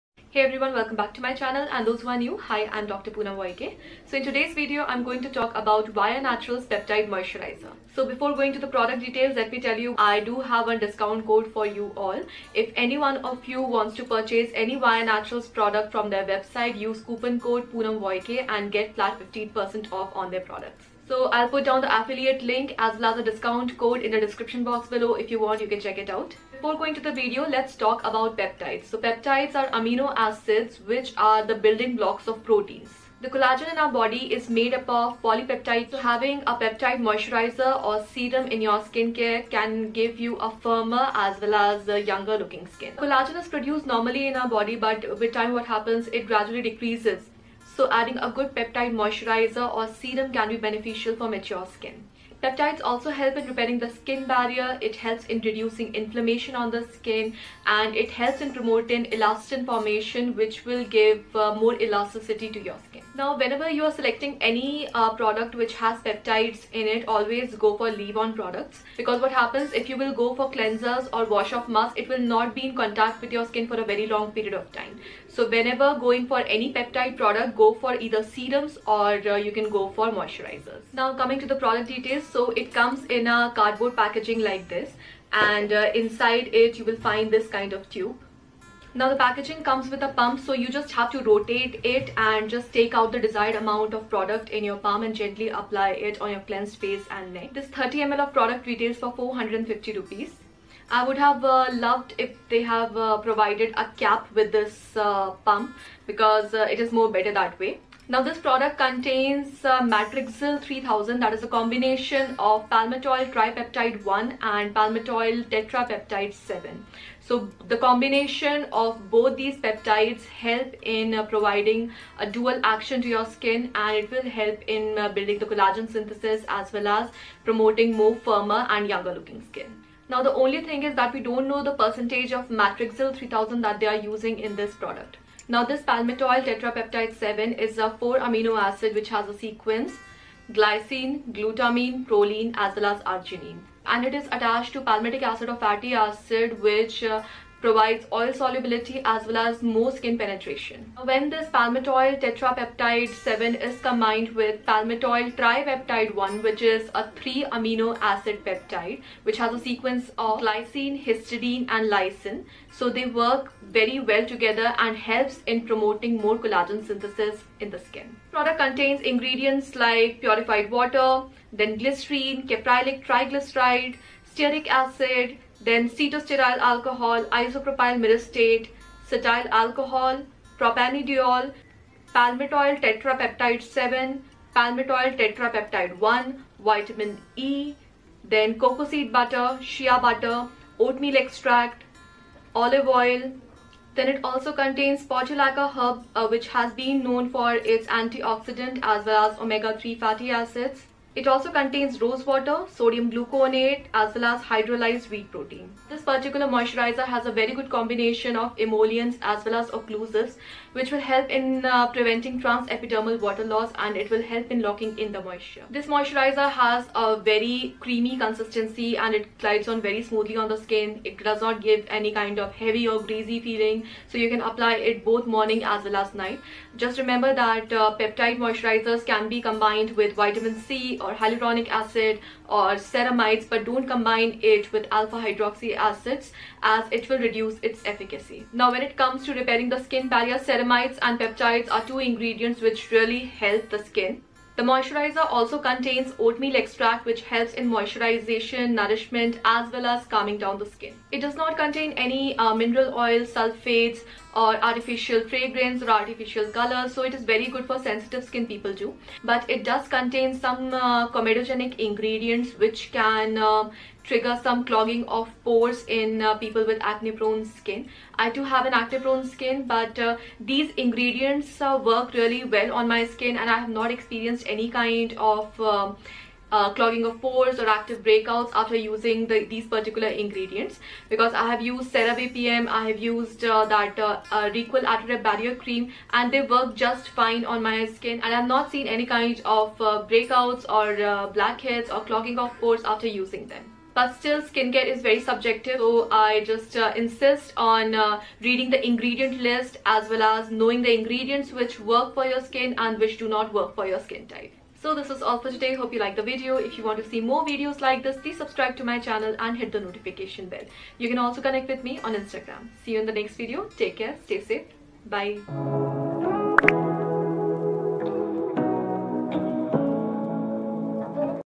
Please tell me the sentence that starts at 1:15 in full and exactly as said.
So whenever going for any peptide product go for either serums or uh, you can go for moisturizers.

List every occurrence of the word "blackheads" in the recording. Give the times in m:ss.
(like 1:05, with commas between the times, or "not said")
4:51.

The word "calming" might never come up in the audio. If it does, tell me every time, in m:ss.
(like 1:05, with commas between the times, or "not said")
4:10.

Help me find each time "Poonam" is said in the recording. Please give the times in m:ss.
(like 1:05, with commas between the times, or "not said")
0:03, 0:17.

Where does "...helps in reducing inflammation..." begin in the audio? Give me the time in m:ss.
0:54.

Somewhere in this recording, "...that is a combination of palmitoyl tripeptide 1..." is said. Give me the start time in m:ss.
1:51.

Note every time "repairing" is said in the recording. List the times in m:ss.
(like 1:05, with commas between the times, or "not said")
0:53, 3:59.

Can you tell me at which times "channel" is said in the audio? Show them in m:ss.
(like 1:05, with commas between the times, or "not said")
0:01, 5:08.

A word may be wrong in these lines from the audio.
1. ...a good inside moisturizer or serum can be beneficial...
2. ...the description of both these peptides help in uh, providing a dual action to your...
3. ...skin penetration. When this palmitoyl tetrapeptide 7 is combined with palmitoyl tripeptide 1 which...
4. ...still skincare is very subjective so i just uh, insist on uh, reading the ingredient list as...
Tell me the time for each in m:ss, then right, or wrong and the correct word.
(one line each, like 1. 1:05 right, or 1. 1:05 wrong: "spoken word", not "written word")
1. 0:48 wrong: "peptide", not "inside"
2. 1:57 wrong: "combination", not "description"
3. 2:29 right
4. 4:54 right.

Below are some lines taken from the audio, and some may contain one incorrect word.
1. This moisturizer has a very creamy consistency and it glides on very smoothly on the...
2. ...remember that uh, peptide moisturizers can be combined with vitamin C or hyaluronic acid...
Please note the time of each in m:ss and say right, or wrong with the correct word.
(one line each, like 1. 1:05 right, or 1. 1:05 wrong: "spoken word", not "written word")
1. 3:35 right
2. 3:46 right.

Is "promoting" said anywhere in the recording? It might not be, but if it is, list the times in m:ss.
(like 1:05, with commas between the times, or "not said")
0:58, 2:07, 2:45.